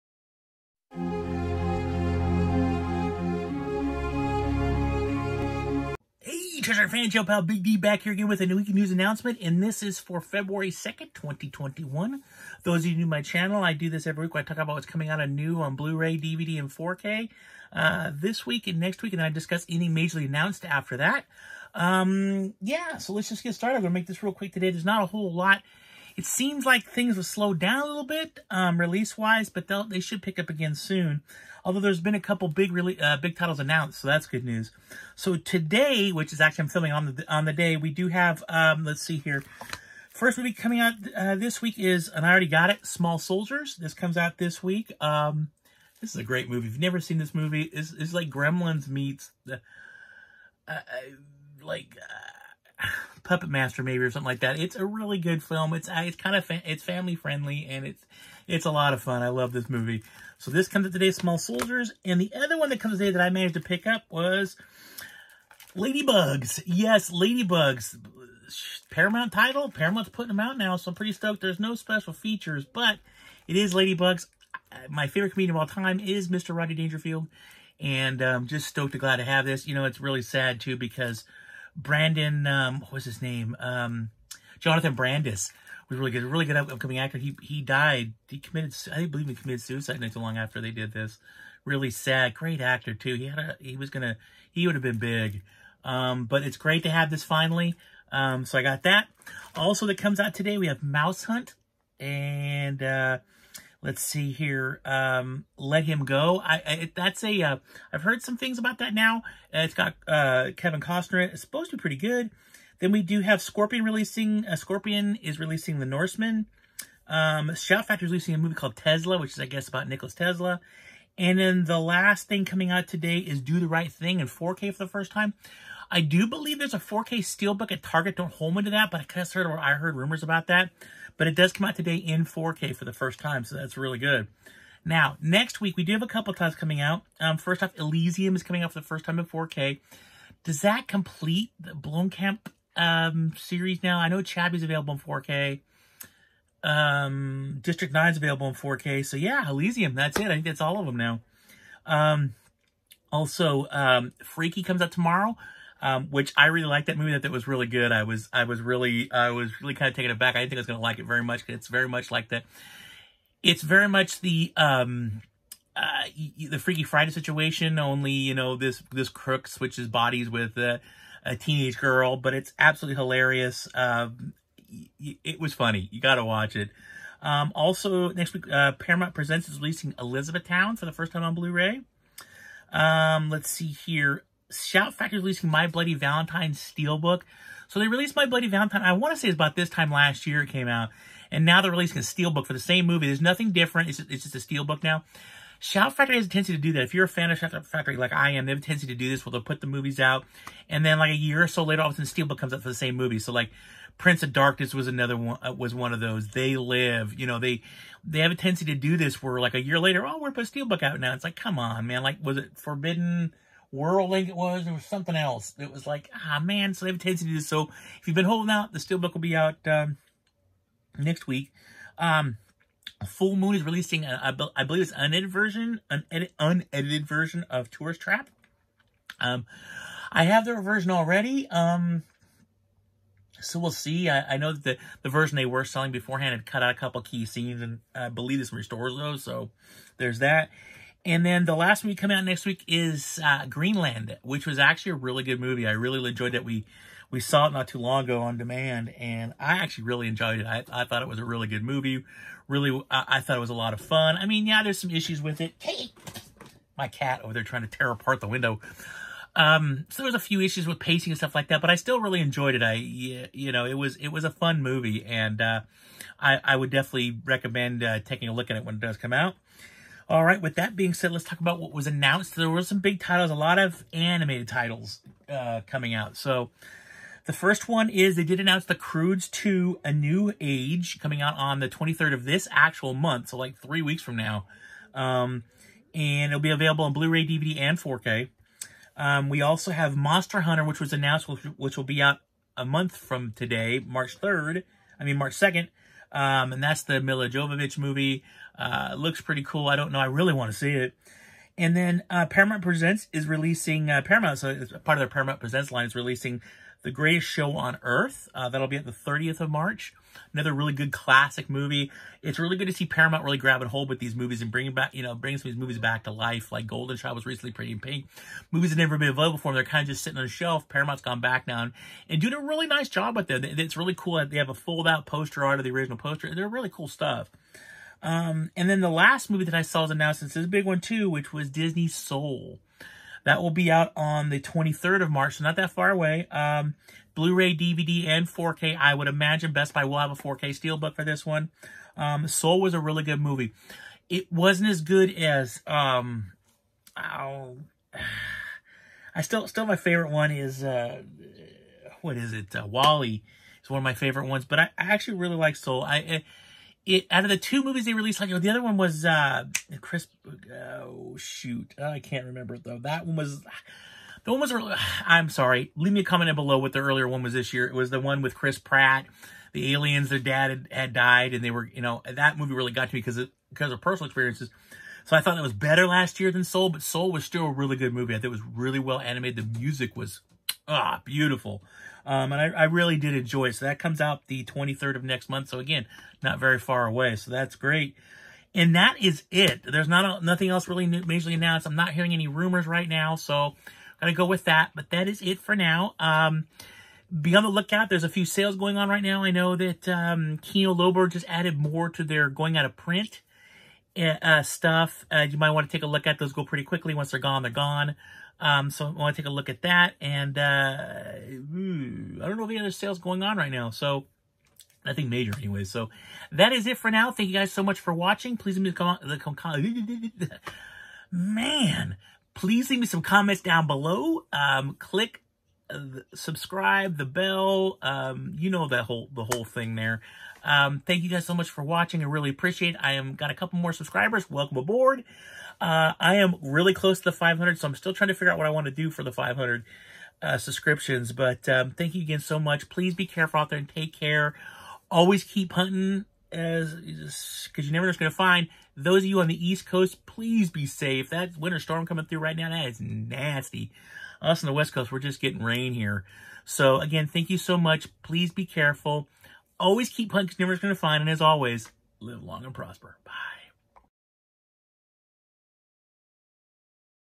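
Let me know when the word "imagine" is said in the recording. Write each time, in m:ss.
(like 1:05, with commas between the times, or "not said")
5:39.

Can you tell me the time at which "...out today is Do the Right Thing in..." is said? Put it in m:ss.
2:02.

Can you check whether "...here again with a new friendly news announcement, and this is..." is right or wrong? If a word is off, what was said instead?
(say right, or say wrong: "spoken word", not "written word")
wrong: "weekly", not "friendly".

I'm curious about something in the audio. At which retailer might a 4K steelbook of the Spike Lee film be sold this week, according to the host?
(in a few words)
Target.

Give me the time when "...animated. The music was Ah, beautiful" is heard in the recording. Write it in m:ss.
6:18.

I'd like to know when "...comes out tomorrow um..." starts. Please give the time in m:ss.
2:34.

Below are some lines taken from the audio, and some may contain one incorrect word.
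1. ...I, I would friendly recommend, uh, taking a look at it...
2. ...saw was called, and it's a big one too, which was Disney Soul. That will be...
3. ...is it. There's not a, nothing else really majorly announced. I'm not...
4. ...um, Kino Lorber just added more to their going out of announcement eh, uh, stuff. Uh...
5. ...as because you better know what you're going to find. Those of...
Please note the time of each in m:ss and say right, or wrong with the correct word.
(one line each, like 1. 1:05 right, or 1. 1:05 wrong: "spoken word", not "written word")
1. 4:26 wrong: "definitely", not "friendly"
2. 5:29 wrong: "announced", not "called"
3. 6:29 right
4. 6:39 wrong: "print", not "announcement"
5. 7:26 wrong: "never", not "better".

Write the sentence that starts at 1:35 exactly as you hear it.
Um, but it's great to have this finally.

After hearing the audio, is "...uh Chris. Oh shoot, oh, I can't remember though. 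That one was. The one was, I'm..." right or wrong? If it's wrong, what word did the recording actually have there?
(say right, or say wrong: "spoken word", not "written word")
right.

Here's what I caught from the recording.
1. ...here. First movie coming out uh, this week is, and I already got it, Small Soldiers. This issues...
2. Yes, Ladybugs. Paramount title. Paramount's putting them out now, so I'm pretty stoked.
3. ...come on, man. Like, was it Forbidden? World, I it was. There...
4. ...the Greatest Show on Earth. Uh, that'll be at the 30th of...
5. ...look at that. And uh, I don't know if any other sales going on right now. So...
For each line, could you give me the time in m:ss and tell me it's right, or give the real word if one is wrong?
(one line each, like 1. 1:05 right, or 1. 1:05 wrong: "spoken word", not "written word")
1. 0:39 wrong: "comes", not "issues"
2. 1:06 right
3. 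3:31 right
4. 5:06 right
5. 6:49 right.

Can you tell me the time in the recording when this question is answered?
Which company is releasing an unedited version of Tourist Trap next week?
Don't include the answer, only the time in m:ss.
3:43.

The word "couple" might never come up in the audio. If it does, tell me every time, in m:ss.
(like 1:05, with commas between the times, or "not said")
0:32, 2:16, 3:56, 7:13.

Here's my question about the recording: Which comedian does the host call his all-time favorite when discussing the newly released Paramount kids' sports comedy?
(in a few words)
Rodney Dangerfield.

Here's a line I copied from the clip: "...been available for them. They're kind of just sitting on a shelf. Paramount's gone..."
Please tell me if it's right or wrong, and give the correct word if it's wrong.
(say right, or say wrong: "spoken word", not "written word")
right.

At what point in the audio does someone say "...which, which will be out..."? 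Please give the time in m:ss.
4:51.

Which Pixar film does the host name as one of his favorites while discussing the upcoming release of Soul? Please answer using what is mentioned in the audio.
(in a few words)
WALL-E.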